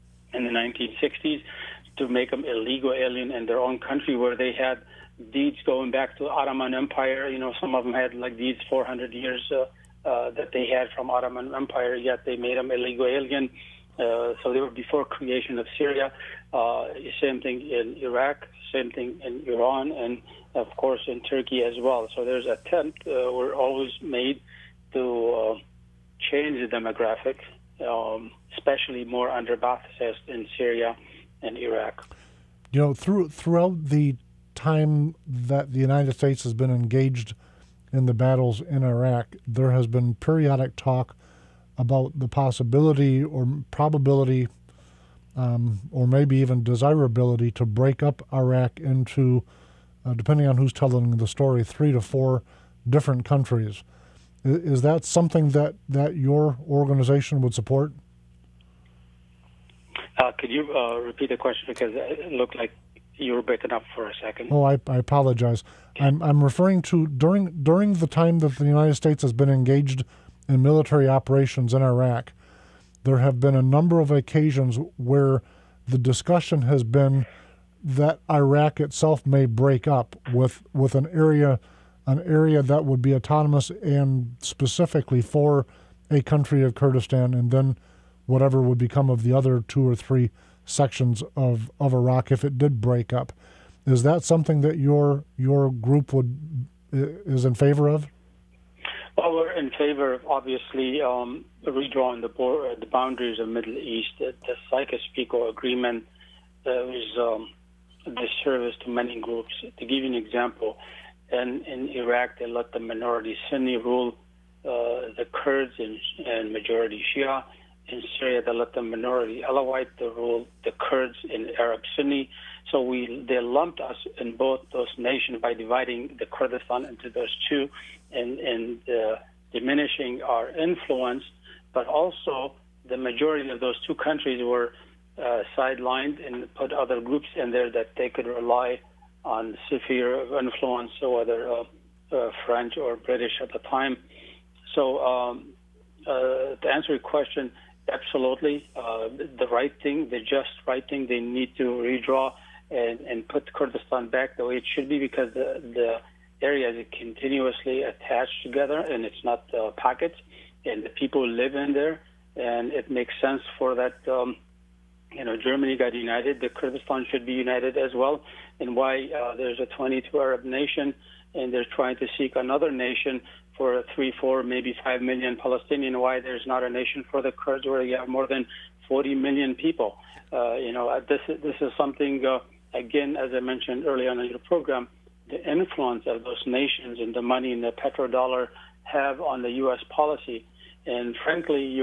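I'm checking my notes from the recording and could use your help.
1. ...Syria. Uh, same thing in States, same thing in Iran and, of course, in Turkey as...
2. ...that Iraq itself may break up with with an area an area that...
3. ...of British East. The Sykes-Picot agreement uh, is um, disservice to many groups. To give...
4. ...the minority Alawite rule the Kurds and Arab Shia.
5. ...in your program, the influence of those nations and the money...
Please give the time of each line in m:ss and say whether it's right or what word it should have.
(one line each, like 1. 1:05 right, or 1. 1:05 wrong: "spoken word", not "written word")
1. 0:15 wrong: "Iraq", not "States"
2. 1:17 right
3. 1:43 wrong: "Middle", not "British"
4. 1:58 wrong: "Sunni", not "Shia"
5. 3:04 right.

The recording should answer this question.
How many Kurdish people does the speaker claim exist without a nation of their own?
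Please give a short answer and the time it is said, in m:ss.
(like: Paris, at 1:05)
more than 40 million, at 2:58.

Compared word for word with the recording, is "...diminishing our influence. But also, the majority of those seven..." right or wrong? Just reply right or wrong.
wrong.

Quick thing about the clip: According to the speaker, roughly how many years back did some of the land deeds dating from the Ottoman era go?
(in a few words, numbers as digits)
400 years.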